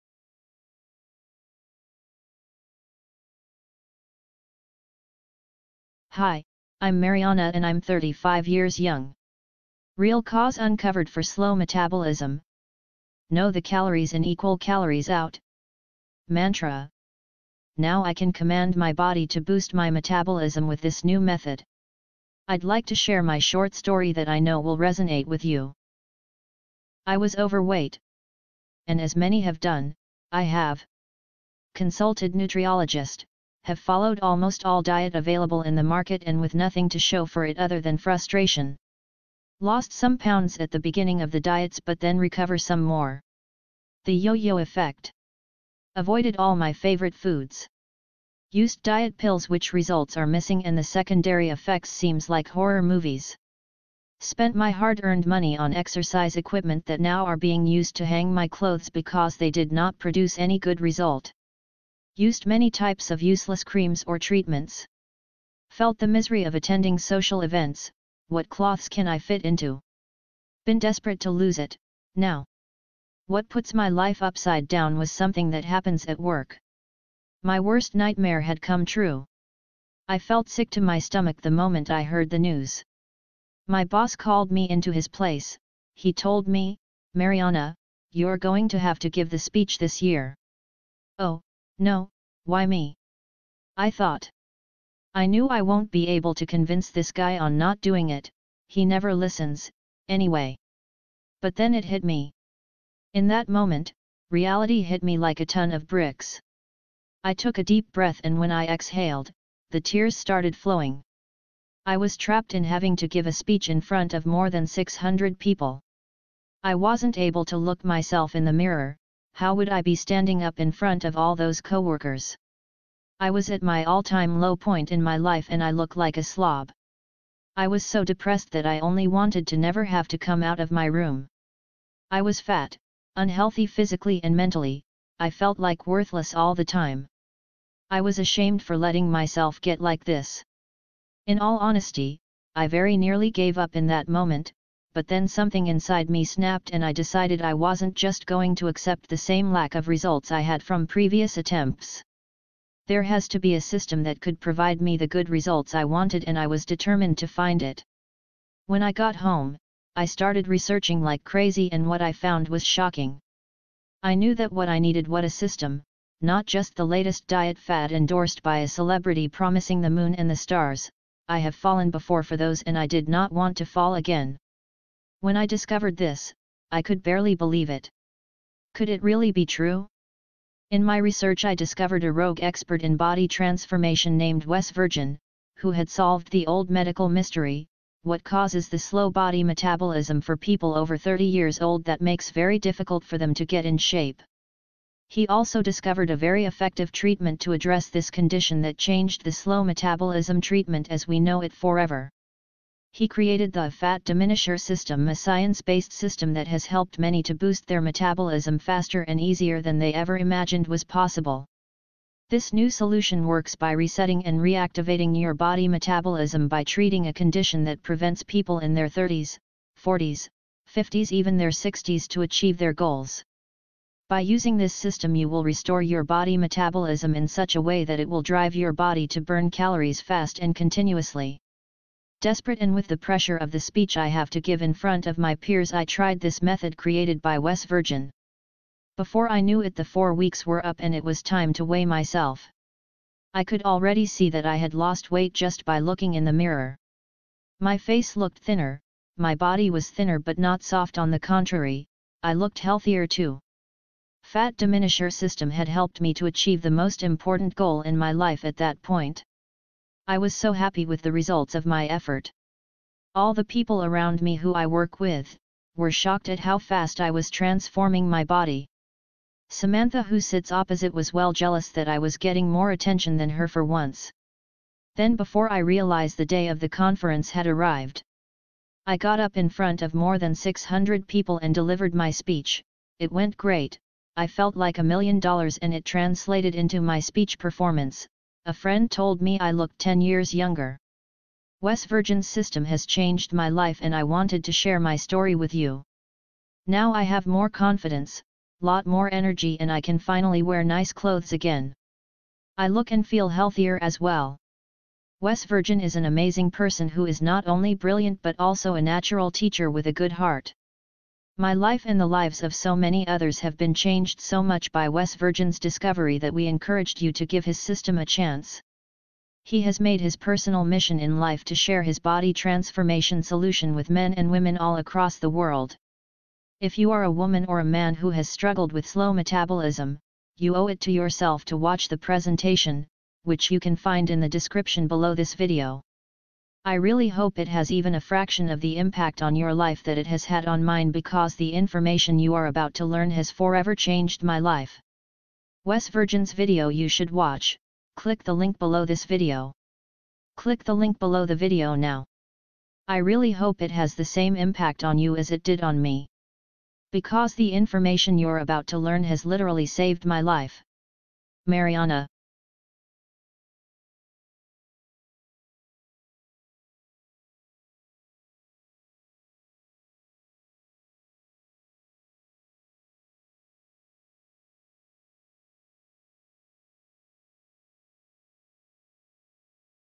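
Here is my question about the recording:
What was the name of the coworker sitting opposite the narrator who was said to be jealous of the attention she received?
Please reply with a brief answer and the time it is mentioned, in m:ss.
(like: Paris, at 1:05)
Samantha, at 4:29.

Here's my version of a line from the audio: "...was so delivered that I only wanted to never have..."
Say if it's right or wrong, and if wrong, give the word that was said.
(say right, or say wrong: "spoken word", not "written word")
wrong: "depressed", not "delivered".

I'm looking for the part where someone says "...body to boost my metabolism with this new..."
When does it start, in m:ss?
0:18.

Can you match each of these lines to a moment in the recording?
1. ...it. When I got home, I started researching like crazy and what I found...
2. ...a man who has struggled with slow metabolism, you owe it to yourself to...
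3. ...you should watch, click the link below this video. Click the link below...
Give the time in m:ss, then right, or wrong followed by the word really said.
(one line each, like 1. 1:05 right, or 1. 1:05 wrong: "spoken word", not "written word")
1. 2:37 right
2. 5:27 right
3. 5:46 right.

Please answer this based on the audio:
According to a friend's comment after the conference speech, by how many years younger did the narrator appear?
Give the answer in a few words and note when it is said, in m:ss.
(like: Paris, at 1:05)
10, at 4:49.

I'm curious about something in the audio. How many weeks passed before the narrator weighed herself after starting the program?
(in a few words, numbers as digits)
4.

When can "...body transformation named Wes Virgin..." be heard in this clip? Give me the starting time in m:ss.
3:02.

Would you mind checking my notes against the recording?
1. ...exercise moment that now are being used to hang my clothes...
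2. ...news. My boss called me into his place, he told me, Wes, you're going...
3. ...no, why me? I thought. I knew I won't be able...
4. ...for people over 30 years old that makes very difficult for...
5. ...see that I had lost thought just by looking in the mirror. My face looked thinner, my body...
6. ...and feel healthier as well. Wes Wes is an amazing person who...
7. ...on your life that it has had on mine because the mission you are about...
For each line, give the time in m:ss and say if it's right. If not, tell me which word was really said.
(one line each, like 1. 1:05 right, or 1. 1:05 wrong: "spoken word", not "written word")
1. 0:55 wrong: "equipment", not "moment"
2. 1:22 wrong: "Mariana", not "Wes"
3. 1:31 right
4. 3:10 right
5. 4:04 wrong: "weight", not "thought"
6. 5:02 wrong: "Virgin", not "Wes"
7. 5:39 wrong: "information", not "mission".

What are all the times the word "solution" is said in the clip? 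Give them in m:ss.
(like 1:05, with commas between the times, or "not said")
3:32, 5:23.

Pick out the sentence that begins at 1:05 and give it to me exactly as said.
Felt the misery of attending social events, what cloths can I fit into?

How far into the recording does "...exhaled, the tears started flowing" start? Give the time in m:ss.
1:48.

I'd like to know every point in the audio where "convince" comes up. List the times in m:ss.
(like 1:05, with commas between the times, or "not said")
1:36.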